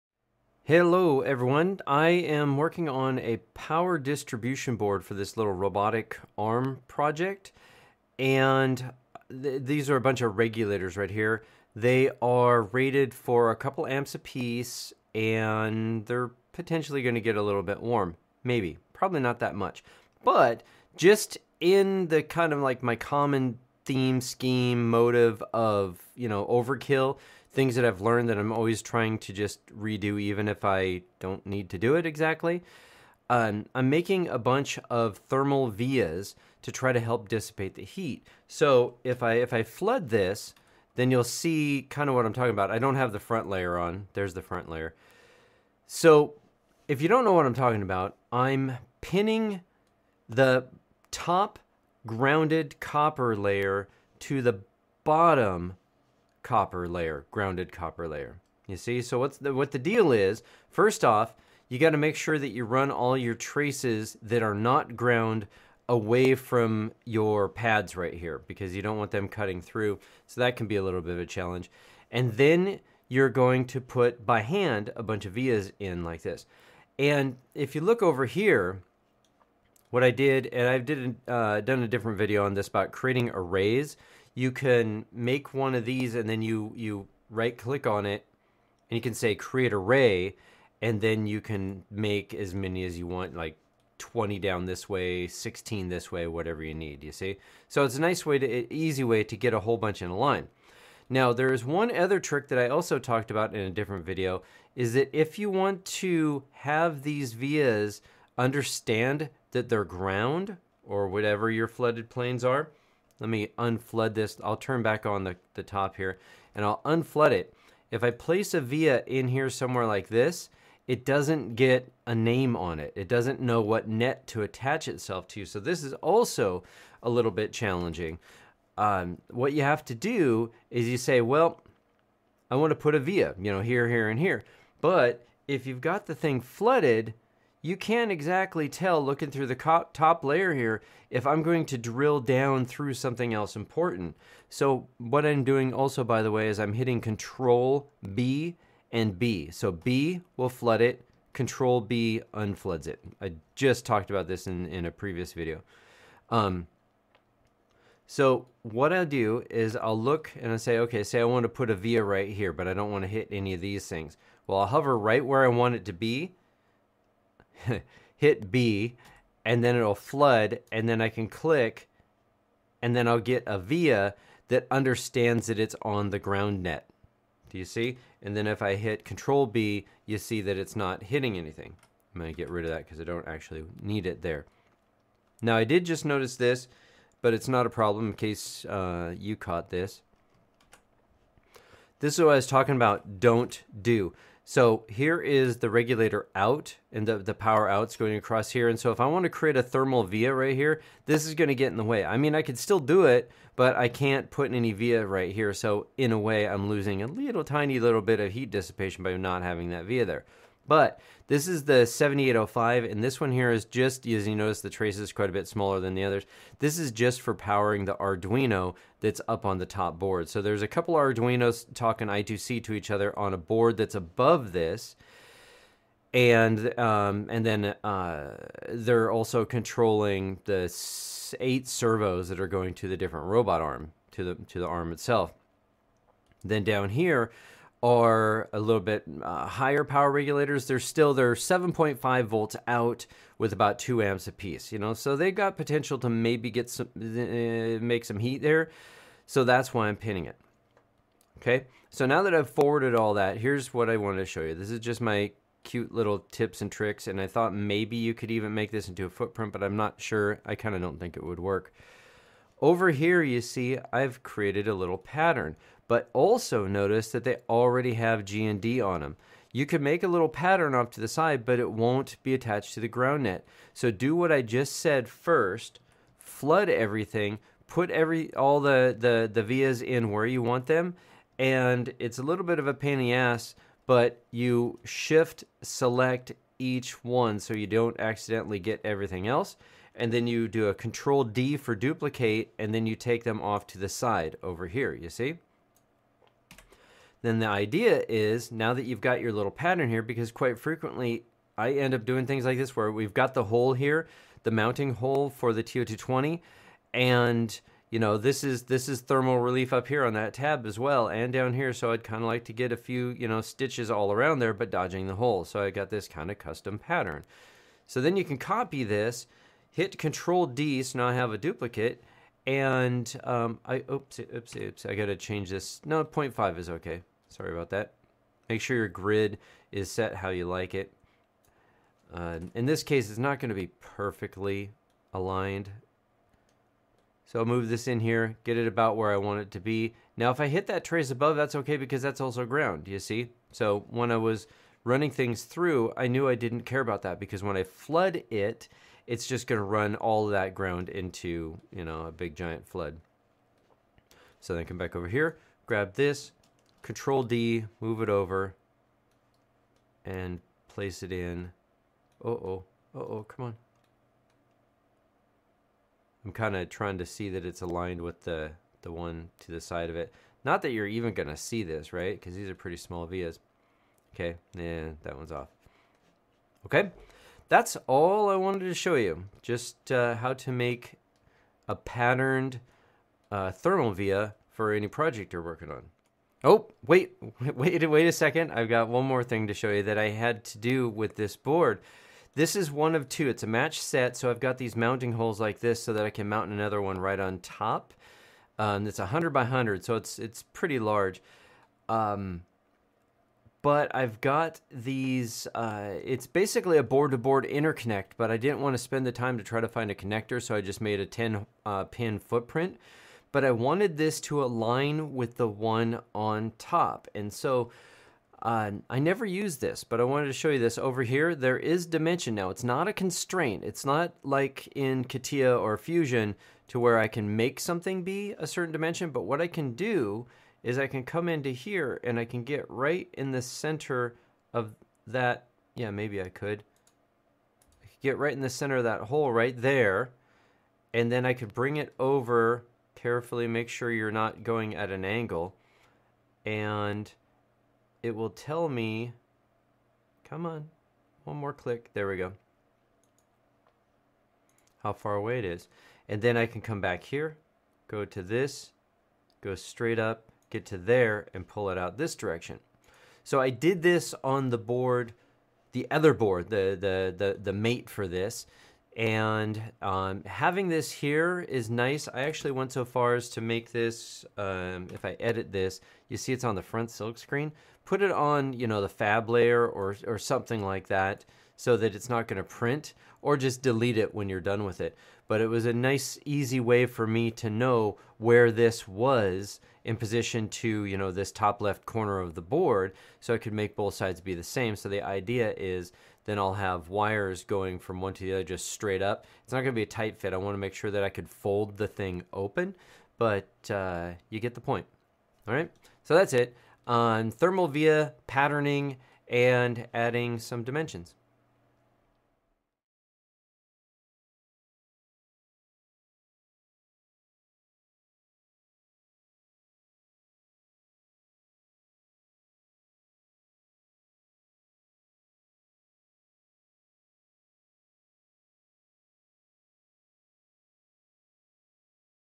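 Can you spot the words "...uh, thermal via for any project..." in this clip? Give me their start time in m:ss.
6:23.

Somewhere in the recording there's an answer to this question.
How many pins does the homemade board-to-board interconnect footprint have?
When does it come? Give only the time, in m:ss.
6:51.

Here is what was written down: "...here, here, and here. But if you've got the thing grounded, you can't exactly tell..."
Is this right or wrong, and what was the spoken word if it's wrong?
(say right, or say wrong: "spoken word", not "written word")
wrong: "flooded", not "grounded".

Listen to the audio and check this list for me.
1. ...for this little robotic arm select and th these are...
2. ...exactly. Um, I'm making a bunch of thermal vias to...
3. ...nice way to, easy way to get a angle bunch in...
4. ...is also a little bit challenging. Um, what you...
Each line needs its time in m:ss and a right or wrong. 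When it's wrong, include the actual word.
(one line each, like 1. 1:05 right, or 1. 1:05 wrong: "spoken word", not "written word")
1. 0:05 wrong: "project", not "select"
2. 0:32 right
3. 1:38 wrong: "whole", not "angle"
4. 2:05 right.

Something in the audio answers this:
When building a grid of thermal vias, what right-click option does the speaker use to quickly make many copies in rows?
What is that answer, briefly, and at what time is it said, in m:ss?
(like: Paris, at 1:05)
create array, at 1:29.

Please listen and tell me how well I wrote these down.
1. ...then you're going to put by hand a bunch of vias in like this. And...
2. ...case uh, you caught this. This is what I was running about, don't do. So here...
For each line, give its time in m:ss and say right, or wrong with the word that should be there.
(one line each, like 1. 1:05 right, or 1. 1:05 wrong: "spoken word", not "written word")
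1. 1:12 right
2. 3:08 wrong: "talking", not "running".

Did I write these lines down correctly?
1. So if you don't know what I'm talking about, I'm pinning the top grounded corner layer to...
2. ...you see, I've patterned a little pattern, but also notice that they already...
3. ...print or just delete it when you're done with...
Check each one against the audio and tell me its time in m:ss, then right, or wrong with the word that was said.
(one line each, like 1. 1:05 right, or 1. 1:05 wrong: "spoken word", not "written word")
1. 0:45 wrong: "copper", not "corner"
2. 4:23 wrong: "created", not "patterned"
3. 8:02 right.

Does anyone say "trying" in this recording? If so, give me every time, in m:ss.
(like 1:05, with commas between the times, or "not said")
0:28, 6:06.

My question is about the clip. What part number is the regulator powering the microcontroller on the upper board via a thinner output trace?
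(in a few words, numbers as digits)
7805.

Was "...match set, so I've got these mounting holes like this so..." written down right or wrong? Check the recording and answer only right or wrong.
right.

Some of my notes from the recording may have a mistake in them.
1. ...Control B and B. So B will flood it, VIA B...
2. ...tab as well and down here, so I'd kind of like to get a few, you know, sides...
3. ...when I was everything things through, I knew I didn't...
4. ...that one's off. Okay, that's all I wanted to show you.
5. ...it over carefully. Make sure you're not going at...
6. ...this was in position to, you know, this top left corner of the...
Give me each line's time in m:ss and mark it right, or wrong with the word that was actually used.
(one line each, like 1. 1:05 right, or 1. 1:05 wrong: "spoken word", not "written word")
1. 2:27 wrong: "Control", not "VIA"
2. 5:10 wrong: "stitches", not "sides"
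3. 5:43 wrong: "running", not "everything"
4. 6:15 right
5. 7:21 right
6. 8:08 right.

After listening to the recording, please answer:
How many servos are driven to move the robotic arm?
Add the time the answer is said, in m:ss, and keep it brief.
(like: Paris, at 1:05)
8, at 3:51.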